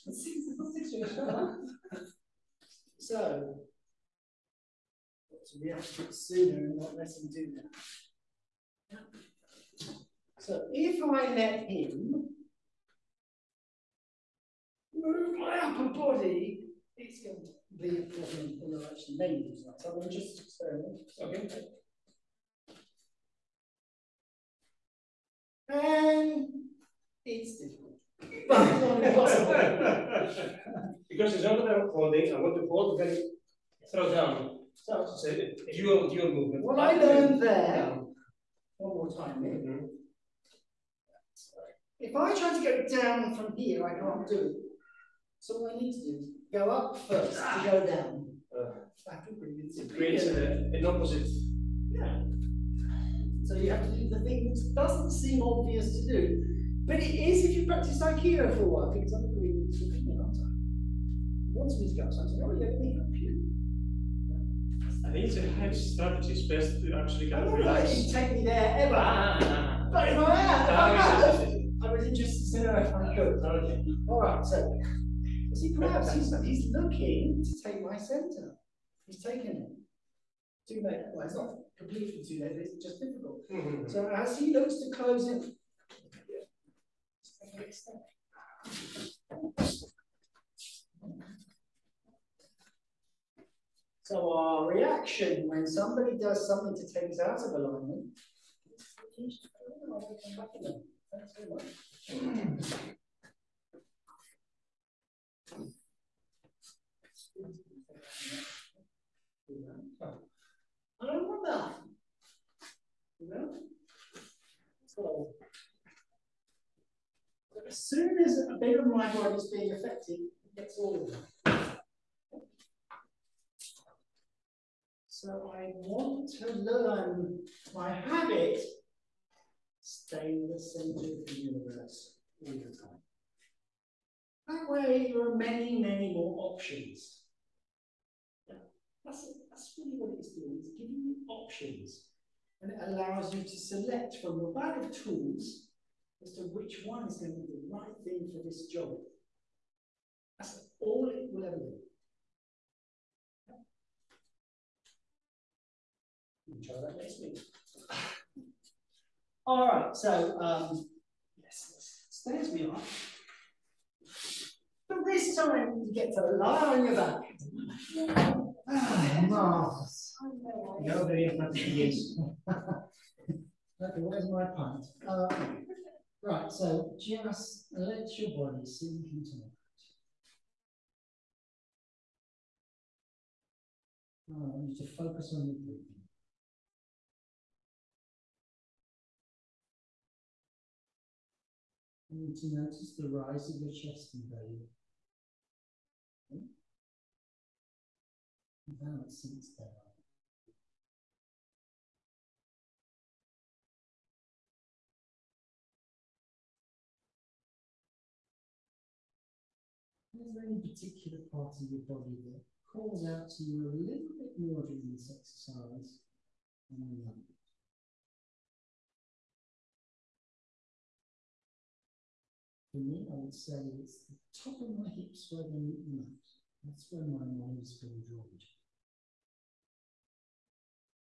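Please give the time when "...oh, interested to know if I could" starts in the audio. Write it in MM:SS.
01:11.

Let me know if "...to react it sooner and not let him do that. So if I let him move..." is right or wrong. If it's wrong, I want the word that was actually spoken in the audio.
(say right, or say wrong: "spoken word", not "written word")
right.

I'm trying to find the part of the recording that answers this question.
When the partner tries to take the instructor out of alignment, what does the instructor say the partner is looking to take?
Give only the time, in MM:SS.
01:17.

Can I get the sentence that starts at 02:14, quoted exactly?
That way, there are many, many more options.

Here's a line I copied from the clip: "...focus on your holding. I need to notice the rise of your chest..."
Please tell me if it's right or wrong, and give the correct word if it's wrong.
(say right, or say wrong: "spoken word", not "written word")
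wrong: "breathing", not "holding".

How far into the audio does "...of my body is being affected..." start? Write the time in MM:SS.
01:58.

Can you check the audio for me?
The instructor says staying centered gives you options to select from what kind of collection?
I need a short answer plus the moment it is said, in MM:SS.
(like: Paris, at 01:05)
a bag of tools, at 02:24.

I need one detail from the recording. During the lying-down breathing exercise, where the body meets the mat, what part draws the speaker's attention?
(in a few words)
top of my hips.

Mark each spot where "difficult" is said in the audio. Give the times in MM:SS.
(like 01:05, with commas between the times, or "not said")
00:27, 01:22.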